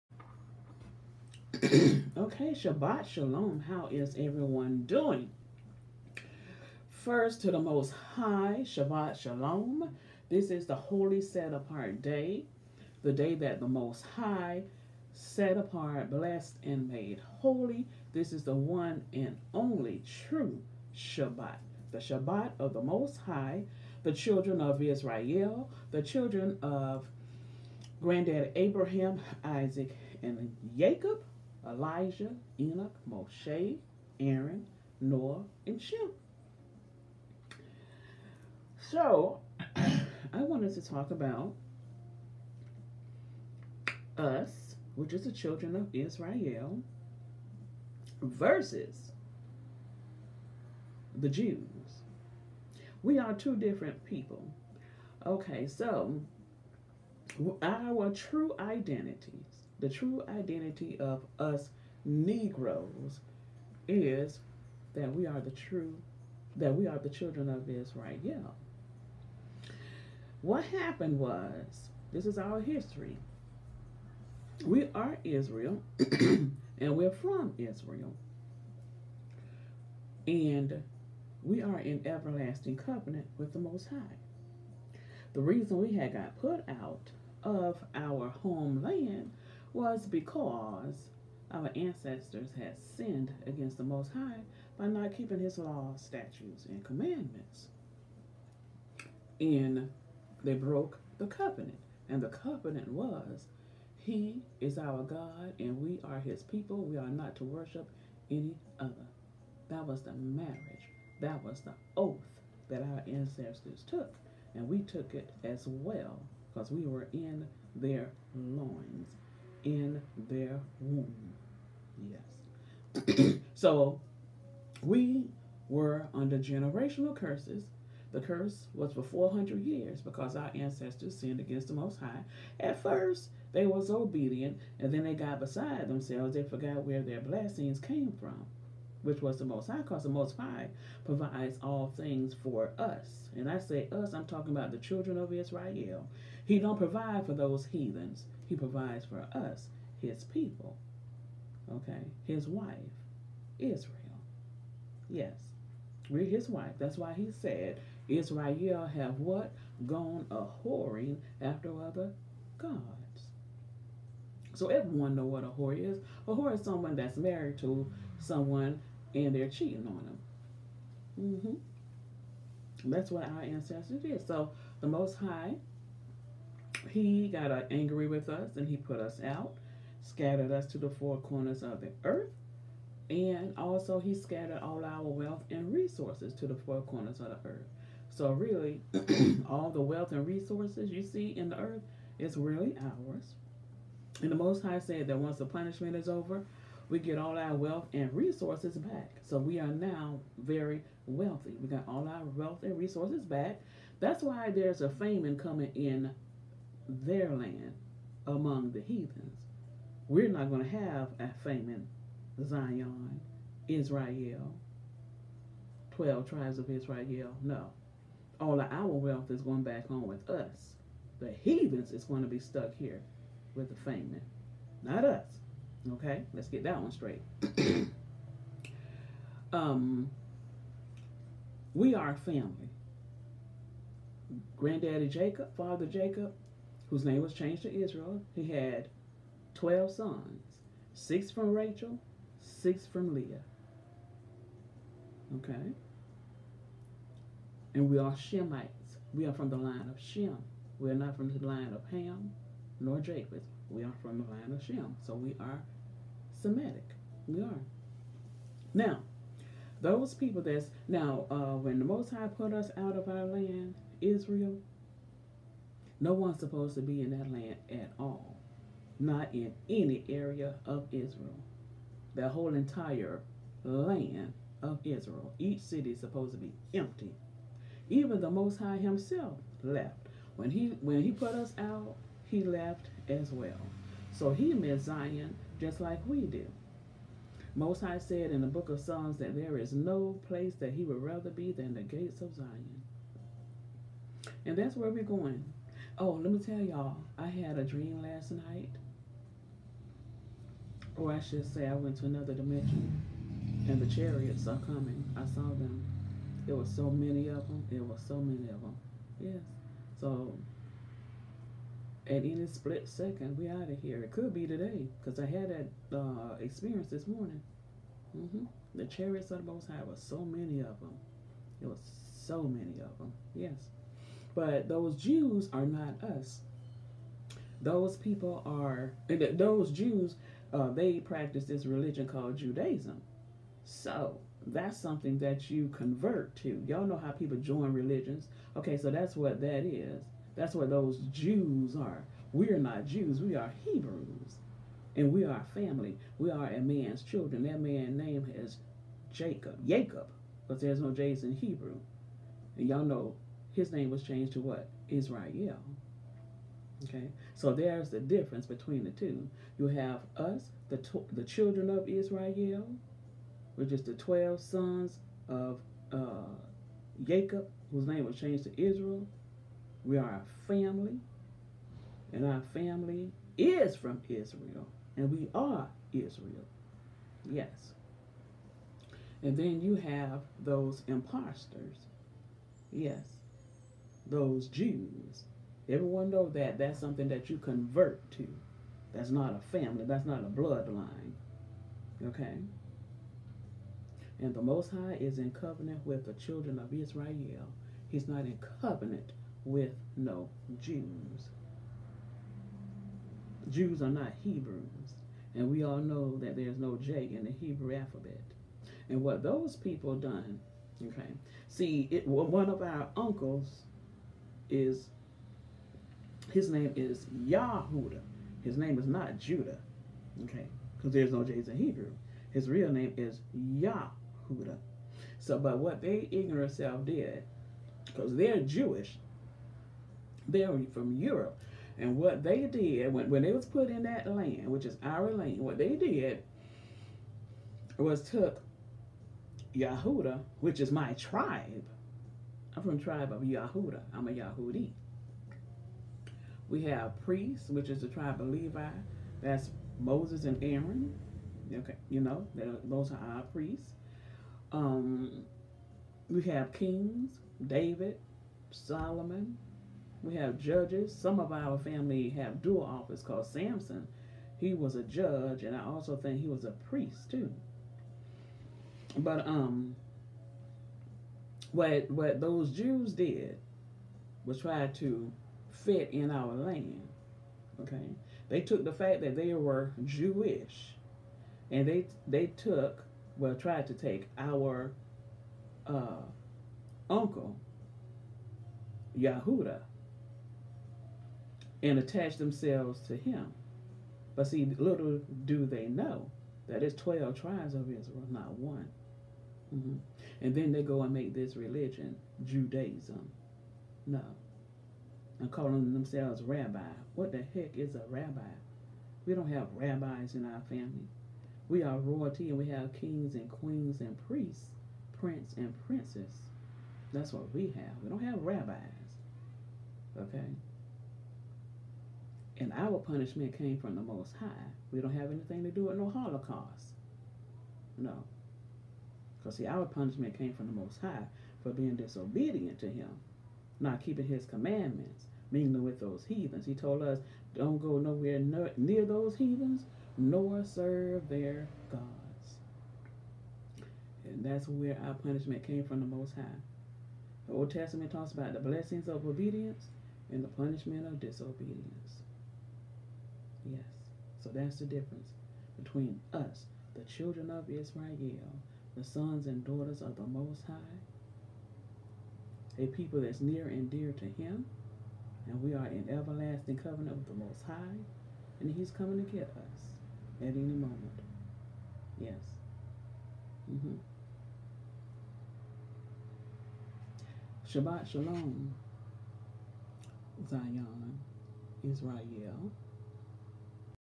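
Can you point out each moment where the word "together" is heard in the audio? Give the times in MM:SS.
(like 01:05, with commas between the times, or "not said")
not said.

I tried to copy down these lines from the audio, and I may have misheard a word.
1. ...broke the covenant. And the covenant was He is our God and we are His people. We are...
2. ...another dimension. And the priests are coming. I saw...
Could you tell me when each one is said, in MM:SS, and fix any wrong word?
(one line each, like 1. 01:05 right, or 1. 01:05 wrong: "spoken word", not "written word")
1. 01:40 right
2. 05:02 wrong: "chariots", not "priests".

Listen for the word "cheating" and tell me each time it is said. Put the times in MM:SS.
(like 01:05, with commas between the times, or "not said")
02:49.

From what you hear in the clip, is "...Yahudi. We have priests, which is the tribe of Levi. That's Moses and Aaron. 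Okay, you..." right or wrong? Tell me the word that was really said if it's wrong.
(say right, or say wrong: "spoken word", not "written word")
right.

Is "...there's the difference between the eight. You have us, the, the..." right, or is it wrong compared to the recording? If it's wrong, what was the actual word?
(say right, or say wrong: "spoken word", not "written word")
wrong: "two", not "eight".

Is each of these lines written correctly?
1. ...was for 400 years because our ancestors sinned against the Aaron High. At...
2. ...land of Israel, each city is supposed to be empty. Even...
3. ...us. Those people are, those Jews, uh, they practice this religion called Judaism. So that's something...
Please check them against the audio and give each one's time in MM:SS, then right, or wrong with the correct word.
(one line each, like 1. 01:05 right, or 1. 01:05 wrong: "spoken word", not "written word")
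1. 02:08 wrong: "Most", not "Aaron"
2. 04:33 right
3. 05:26 right.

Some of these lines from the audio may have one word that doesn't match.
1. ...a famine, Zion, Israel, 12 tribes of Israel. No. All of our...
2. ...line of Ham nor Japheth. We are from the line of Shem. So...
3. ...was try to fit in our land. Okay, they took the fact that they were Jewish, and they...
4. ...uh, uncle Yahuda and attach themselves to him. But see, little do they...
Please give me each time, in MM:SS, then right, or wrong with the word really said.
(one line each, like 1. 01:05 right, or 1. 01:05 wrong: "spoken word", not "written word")
1. 03:31 right
2. 04:11 right
3. 07:54 right
4. 08:05 right.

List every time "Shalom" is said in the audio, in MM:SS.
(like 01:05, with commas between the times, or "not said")
00:03, 00:09, 09:37.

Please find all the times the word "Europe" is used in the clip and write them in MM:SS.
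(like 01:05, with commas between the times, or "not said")
07:10.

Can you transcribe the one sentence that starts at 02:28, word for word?
He provides for us, his people.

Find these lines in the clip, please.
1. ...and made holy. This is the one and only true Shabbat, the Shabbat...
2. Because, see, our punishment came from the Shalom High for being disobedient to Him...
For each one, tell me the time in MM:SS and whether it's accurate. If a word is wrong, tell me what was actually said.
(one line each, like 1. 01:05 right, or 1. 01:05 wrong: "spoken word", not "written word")
1. 00:16 right
2. 08:49 wrong: "Most", not "Shalom".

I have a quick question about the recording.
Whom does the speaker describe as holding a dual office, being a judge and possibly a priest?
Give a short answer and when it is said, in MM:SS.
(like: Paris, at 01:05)
Samson, at 07:43.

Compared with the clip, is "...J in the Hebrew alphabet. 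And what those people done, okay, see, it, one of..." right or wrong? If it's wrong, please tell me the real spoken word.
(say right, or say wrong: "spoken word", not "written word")
right.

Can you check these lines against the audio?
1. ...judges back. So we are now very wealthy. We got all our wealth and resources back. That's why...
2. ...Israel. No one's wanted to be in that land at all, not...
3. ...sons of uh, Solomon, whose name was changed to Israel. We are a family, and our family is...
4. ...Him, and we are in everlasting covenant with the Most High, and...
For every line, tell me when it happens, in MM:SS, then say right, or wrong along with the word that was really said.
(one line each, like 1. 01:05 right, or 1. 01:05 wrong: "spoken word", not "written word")
1. 03:18 wrong: "resources", not "judges"
2. 04:24 wrong: "supposed", not "wanted"
3. 06:04 wrong: "Jacob", not "Solomon"
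4. 09:24 right.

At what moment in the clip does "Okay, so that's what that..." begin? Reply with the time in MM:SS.
05:38.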